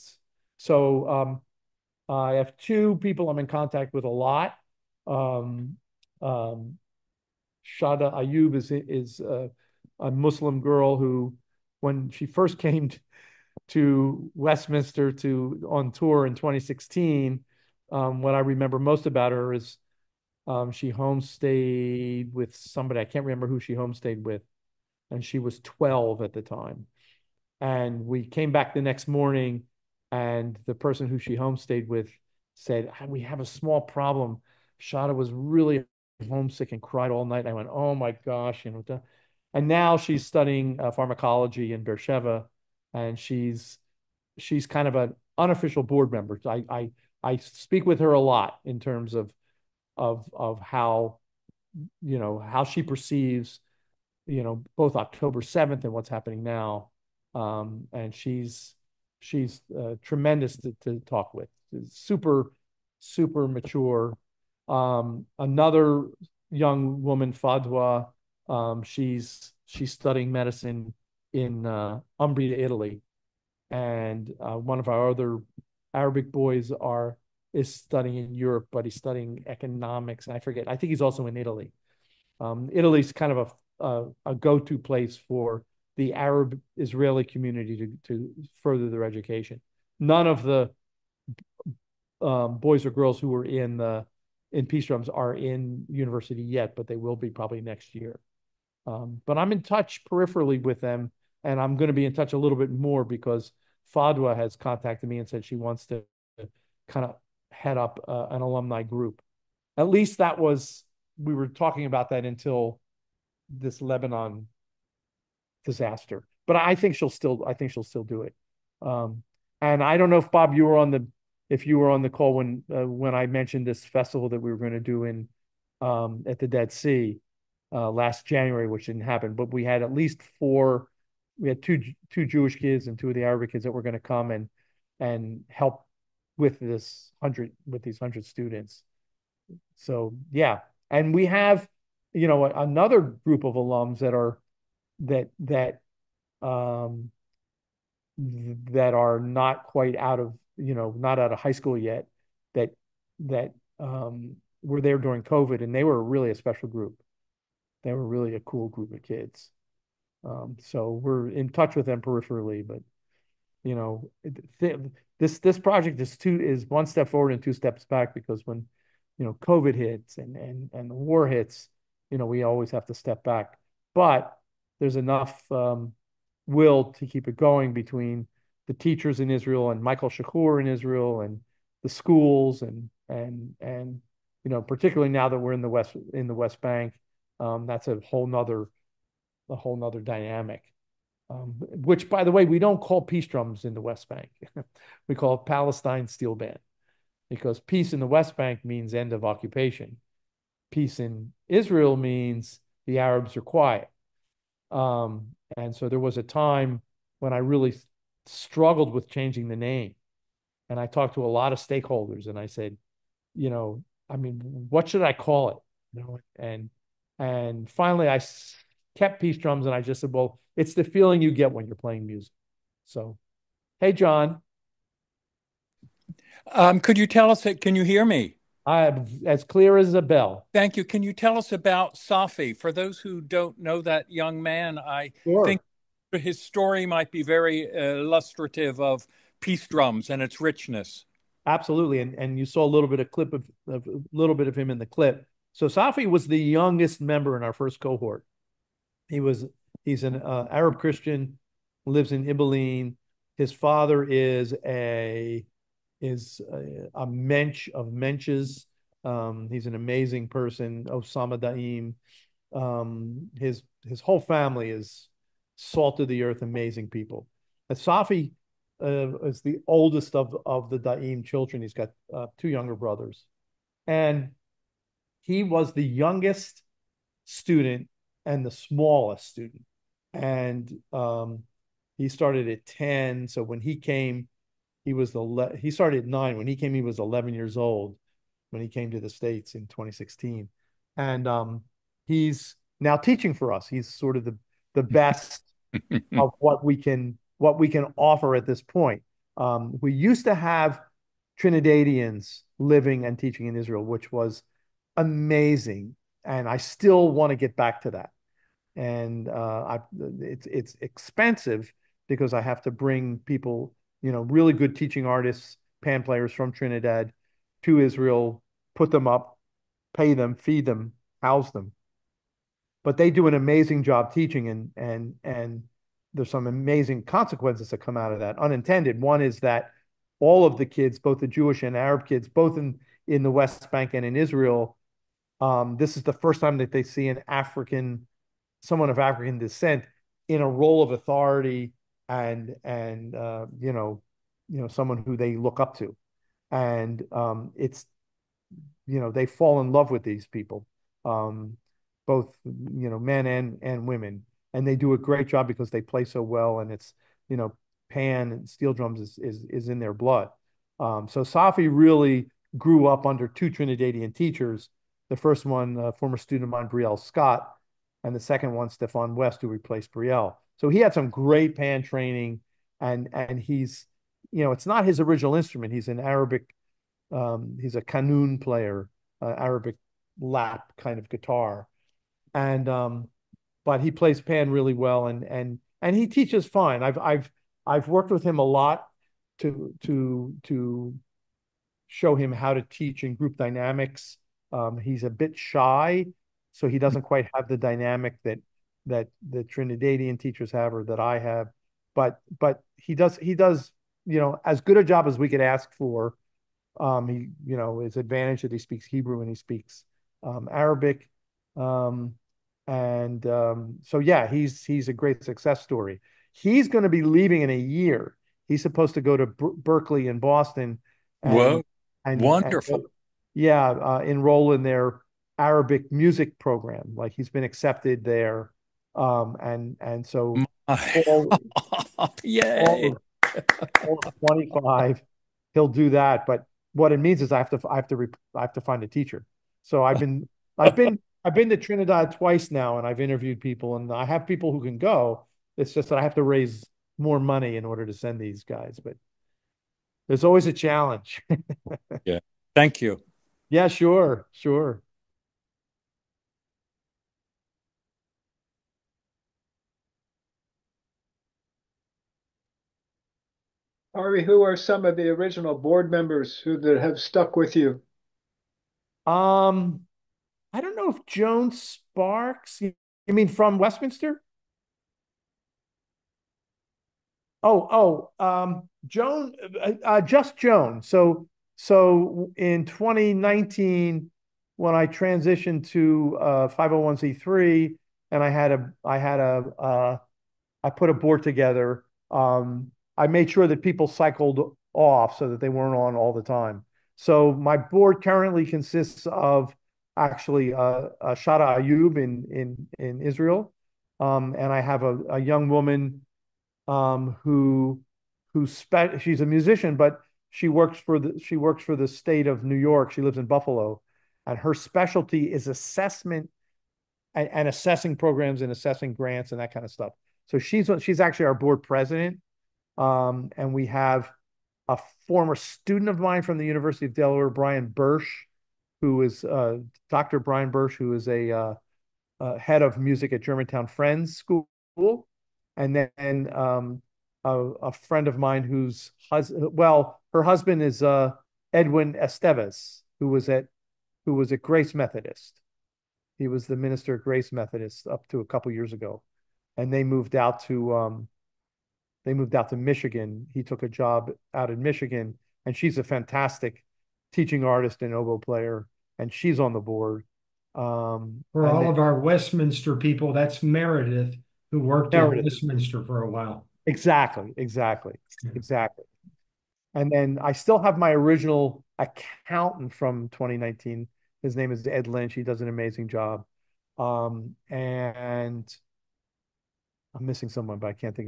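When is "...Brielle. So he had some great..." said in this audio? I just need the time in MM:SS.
06:09.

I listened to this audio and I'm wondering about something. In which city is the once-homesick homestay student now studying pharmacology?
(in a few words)
Beersheba.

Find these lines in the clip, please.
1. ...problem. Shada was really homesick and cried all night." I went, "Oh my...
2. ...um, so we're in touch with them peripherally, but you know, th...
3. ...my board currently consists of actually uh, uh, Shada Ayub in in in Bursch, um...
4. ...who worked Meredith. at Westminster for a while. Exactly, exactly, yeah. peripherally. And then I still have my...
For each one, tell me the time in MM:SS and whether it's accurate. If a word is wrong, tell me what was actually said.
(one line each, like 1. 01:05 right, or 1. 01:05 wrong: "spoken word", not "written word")
1. 00:33 right
2. 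02:40 right
3. 08:17 wrong: "Israel", not "Bursch"
4. 09:24 wrong: "exactly", not "peripherally".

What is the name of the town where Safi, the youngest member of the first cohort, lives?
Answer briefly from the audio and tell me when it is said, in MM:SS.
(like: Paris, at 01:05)
Ibilin, at 04:12.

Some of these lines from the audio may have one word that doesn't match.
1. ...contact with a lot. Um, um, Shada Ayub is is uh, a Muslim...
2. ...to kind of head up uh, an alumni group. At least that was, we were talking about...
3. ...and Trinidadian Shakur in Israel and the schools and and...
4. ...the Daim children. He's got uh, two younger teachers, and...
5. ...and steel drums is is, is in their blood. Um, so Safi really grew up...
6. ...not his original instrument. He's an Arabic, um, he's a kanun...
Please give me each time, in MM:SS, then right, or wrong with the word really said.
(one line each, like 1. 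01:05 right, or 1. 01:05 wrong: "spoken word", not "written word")
1. 00:03 right
2. 01:45 right
3. 02:59 wrong: "Michael", not "Trinidadian"
4. 04:30 wrong: "brothers", not "teachers"
5. 05:58 right
6. 06:14 right.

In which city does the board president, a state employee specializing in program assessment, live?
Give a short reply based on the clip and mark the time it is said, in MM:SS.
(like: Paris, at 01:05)
Buffalo, at 08:33.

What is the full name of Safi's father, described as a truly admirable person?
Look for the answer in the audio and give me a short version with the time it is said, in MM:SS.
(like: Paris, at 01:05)
Osama Daim, at 04:20.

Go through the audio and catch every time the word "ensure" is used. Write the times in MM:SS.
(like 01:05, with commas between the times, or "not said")
not said.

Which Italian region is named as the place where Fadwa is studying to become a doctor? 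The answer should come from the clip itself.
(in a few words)
Umbria.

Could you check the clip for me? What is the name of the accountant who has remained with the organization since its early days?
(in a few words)
Ed Lynch.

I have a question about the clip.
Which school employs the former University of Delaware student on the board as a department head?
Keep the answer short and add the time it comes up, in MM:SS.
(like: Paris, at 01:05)
Germantown Friends School, at 08:53.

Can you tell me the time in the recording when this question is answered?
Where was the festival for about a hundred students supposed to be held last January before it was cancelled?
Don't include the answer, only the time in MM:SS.
02:06.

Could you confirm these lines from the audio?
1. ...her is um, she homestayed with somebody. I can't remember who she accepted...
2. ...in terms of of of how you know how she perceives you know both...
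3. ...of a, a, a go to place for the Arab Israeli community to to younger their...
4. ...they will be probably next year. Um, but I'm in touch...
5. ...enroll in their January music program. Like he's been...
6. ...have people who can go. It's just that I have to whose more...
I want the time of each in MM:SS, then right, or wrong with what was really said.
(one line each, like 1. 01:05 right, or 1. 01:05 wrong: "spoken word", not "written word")
1. 00:19 wrong: "homestayed", not "accepted"
2. 00:48 right
3. 01:23 wrong: "further", not "younger"
4. 01:36 right
5. 07:04 wrong: "Arabic", not "January"
6. 07:24 wrong: "raise", not "whose".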